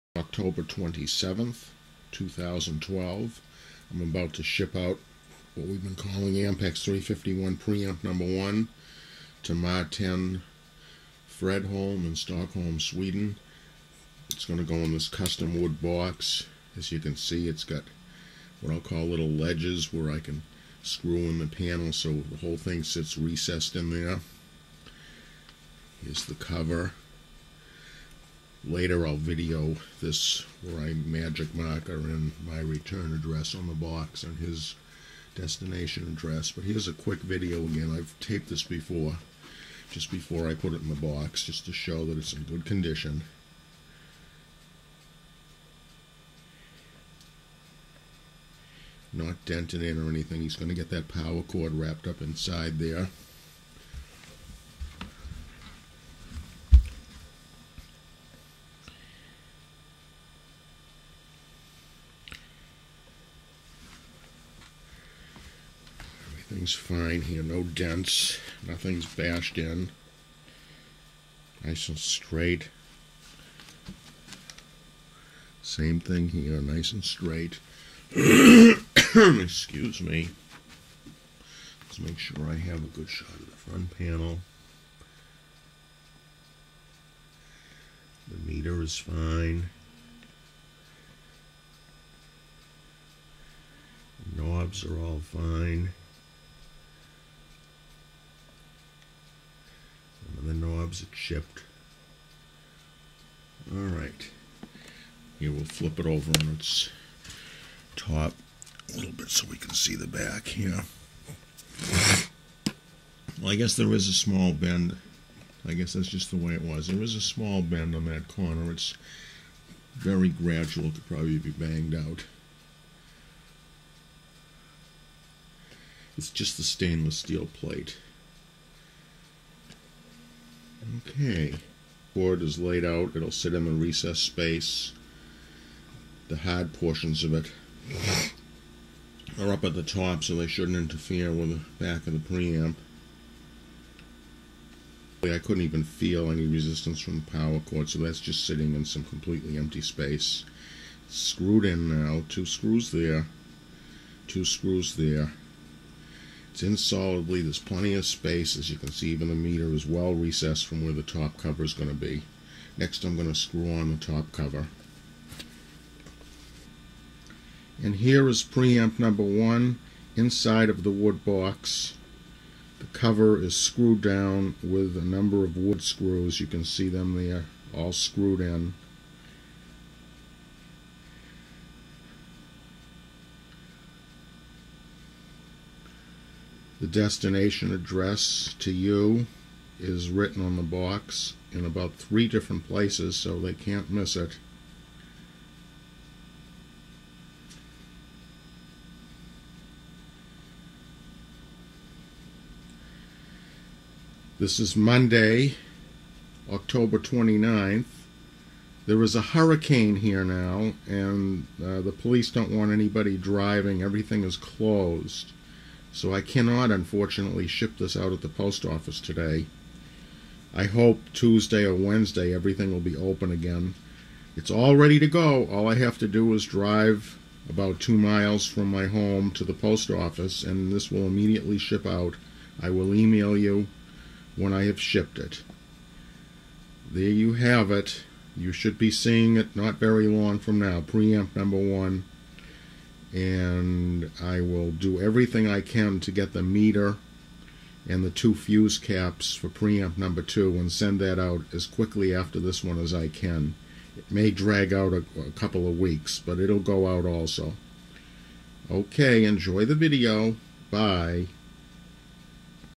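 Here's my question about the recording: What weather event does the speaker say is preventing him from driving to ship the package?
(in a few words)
Hurricane.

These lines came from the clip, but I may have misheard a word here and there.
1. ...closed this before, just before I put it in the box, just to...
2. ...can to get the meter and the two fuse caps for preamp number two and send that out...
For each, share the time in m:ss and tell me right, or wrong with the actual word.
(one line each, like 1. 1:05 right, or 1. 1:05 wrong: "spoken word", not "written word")
1. 0:38 wrong: "taped", not "closed"
2. 4:05 right.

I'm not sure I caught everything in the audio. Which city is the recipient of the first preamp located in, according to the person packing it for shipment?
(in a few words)
Stockholm.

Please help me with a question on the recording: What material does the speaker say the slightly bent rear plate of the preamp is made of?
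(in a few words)
Stainless steel.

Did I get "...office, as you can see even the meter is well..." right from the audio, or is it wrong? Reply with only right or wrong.
wrong.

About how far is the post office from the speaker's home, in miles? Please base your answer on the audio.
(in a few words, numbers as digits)
2.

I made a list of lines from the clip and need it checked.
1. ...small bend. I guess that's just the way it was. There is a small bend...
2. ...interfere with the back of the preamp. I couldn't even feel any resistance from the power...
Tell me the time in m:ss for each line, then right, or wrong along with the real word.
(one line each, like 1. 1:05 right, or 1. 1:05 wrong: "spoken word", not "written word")
1. 1:54 right
2. 2:20 right.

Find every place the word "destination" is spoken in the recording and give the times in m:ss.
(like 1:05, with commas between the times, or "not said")
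0:35, 3:06.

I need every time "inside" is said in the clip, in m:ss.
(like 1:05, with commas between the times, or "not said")
0:52, 2:50.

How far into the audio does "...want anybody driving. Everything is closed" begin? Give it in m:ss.
3:32.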